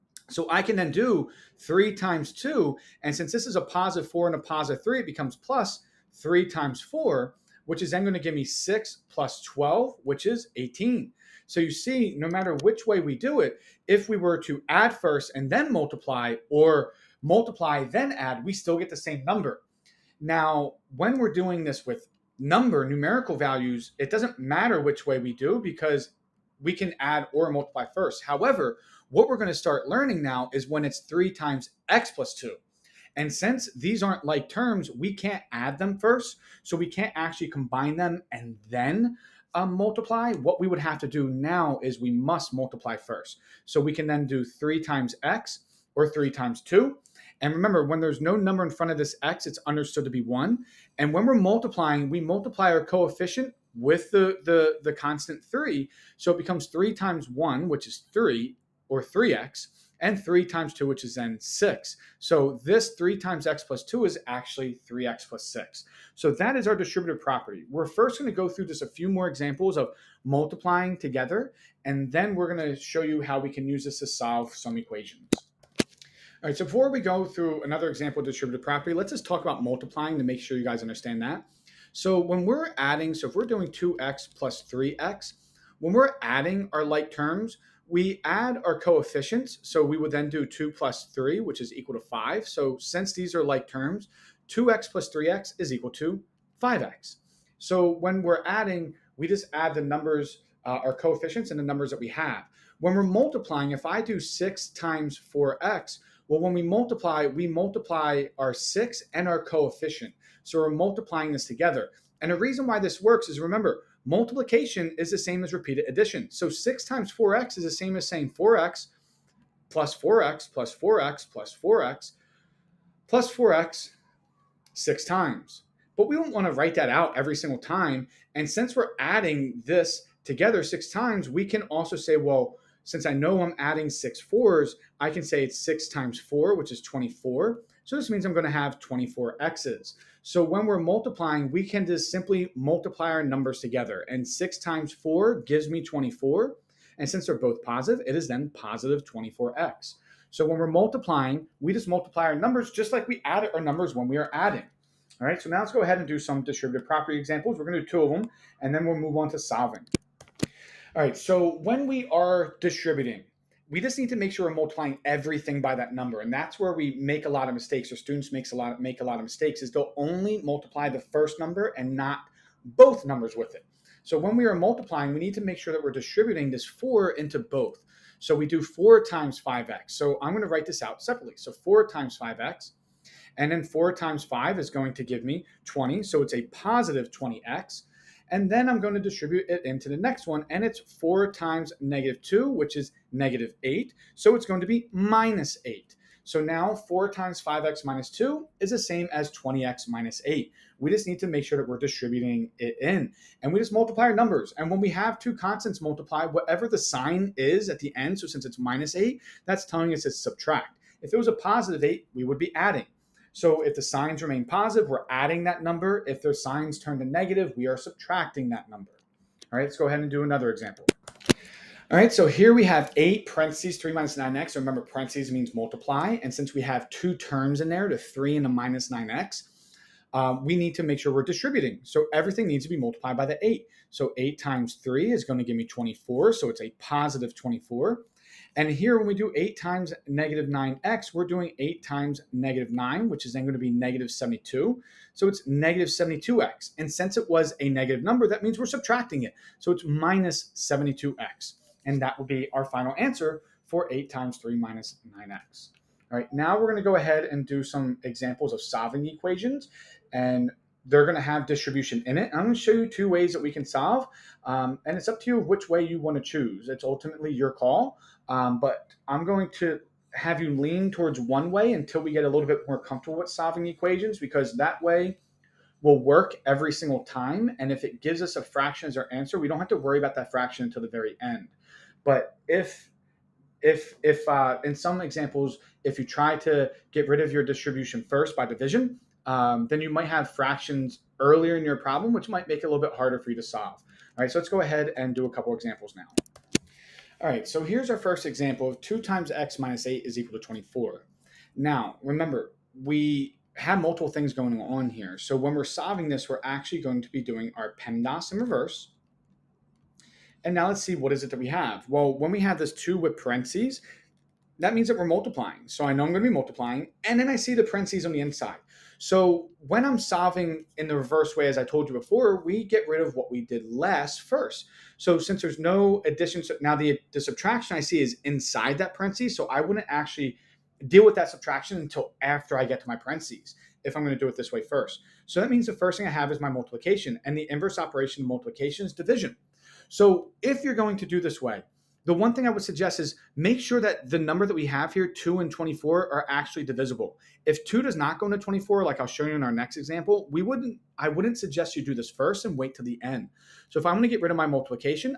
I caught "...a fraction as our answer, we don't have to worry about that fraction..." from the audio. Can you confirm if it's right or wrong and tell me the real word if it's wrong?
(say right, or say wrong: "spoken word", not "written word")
right.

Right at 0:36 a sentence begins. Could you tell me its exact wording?
So we can't actually combine them and then um, multiply.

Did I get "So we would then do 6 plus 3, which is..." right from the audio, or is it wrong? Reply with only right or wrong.
wrong.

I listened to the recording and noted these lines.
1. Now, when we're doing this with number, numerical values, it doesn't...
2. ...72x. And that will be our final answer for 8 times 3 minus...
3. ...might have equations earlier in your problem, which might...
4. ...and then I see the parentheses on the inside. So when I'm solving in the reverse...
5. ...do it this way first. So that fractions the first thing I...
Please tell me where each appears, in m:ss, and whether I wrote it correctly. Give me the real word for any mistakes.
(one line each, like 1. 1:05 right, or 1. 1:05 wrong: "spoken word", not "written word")
1. 0:20 right
2. 4:10 right
3. 4:49 wrong: "fractions", not "equations"
4. 5:17 right
5. 5:34 wrong: "means", not "fractions".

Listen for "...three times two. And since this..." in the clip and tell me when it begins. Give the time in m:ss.
0:01.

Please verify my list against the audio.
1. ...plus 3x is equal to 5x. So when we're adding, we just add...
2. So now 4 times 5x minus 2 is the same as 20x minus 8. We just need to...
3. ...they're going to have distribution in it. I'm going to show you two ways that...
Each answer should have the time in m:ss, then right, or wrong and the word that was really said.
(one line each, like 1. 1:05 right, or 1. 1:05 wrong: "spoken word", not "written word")
1. 1:34 right
2. 3:16 right
3. 4:20 right.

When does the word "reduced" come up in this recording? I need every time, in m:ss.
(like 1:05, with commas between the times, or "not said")
not said.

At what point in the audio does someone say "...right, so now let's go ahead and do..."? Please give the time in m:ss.
2:35.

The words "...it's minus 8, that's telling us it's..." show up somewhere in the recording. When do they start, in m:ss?
3:28.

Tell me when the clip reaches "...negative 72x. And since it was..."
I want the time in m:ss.
4:05.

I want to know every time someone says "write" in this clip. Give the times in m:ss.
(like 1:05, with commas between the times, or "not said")
2:06, 3:00.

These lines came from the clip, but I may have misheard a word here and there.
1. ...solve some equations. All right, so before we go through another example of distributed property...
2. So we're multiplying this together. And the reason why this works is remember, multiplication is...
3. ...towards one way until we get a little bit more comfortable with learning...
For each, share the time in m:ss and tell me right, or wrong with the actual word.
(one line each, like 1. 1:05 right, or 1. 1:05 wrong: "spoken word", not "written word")
1. 1:14 right
2. 1:50 right
3. 4:30 wrong: "solving", not "learning".